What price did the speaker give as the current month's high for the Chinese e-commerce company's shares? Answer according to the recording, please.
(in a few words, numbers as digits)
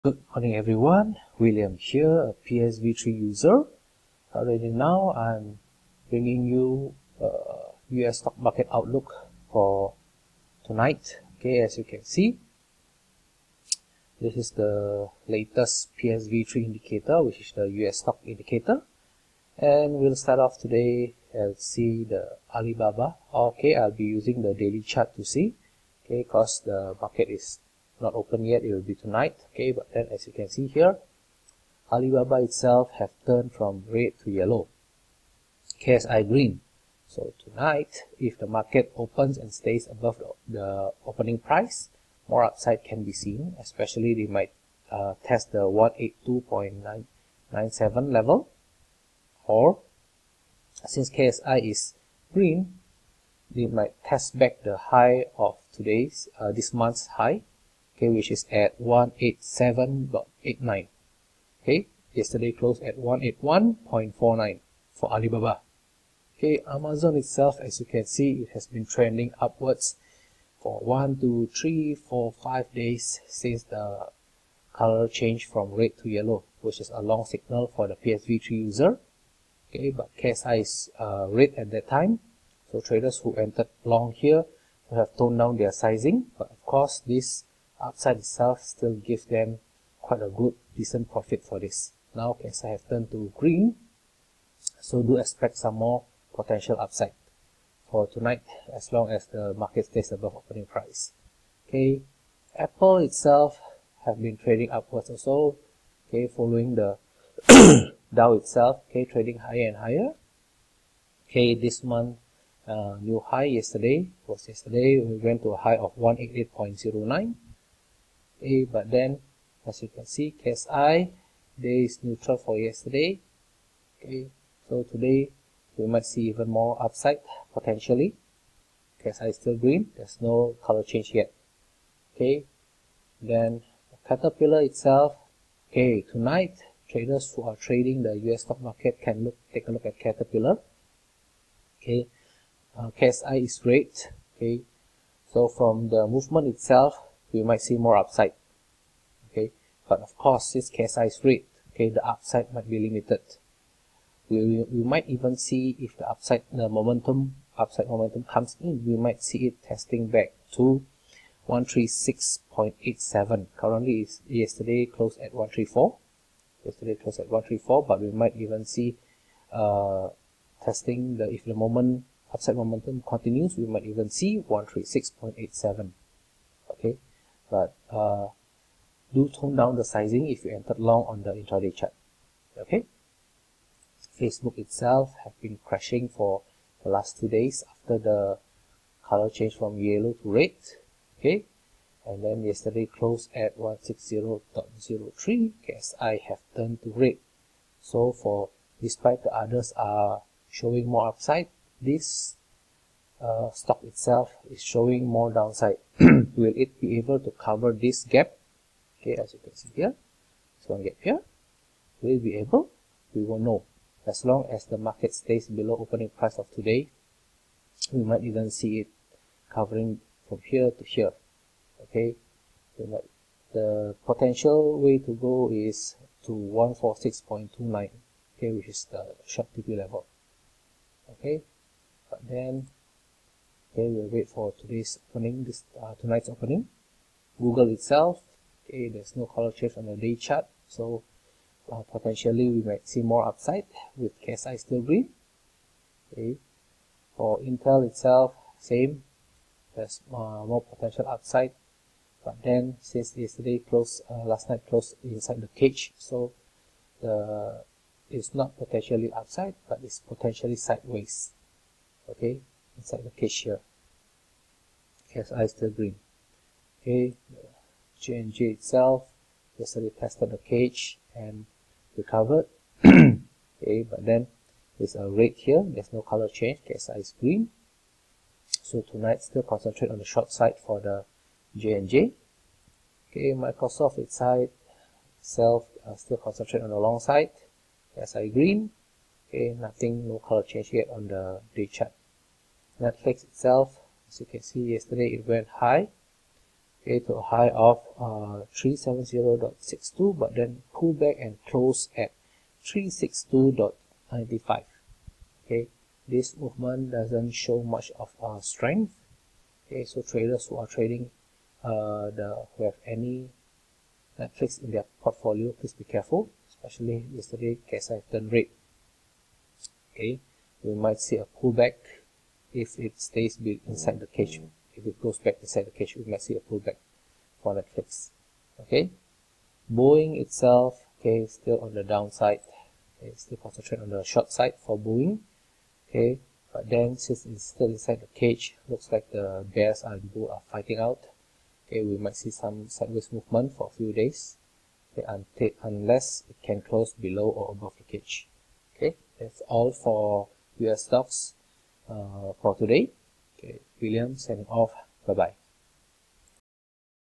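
187.89.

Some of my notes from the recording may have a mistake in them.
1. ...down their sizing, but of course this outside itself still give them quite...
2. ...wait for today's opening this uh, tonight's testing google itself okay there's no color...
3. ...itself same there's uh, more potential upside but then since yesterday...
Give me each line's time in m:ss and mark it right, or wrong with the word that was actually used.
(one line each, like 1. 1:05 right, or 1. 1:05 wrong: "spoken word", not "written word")
1. 1:25 right
2. 3:54 wrong: "opening", not "testing"
3. 4:07 right.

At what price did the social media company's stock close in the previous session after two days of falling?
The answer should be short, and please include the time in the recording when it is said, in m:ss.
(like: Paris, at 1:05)
160.03, at 3:13.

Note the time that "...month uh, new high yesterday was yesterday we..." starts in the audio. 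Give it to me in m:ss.
1:51.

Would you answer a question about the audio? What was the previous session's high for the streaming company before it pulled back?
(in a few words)
370.62.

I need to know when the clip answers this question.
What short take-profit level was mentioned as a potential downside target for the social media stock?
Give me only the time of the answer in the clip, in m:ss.
3:46.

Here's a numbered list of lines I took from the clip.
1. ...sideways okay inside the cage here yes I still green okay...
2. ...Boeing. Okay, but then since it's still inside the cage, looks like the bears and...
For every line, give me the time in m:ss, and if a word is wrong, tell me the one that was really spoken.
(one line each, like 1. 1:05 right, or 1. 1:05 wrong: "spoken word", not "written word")
1. 4:20 right
2. 5:34 right.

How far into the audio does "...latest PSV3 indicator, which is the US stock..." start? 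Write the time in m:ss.
0:15.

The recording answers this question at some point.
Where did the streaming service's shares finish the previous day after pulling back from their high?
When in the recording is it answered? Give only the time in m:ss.
5:02.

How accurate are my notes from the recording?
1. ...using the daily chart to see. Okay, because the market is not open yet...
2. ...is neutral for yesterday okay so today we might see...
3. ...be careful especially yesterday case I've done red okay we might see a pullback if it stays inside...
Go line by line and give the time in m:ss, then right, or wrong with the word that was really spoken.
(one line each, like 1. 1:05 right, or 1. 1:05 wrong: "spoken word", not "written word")
1. 0:24 right
2. 2:01 right
3. 5:15 right.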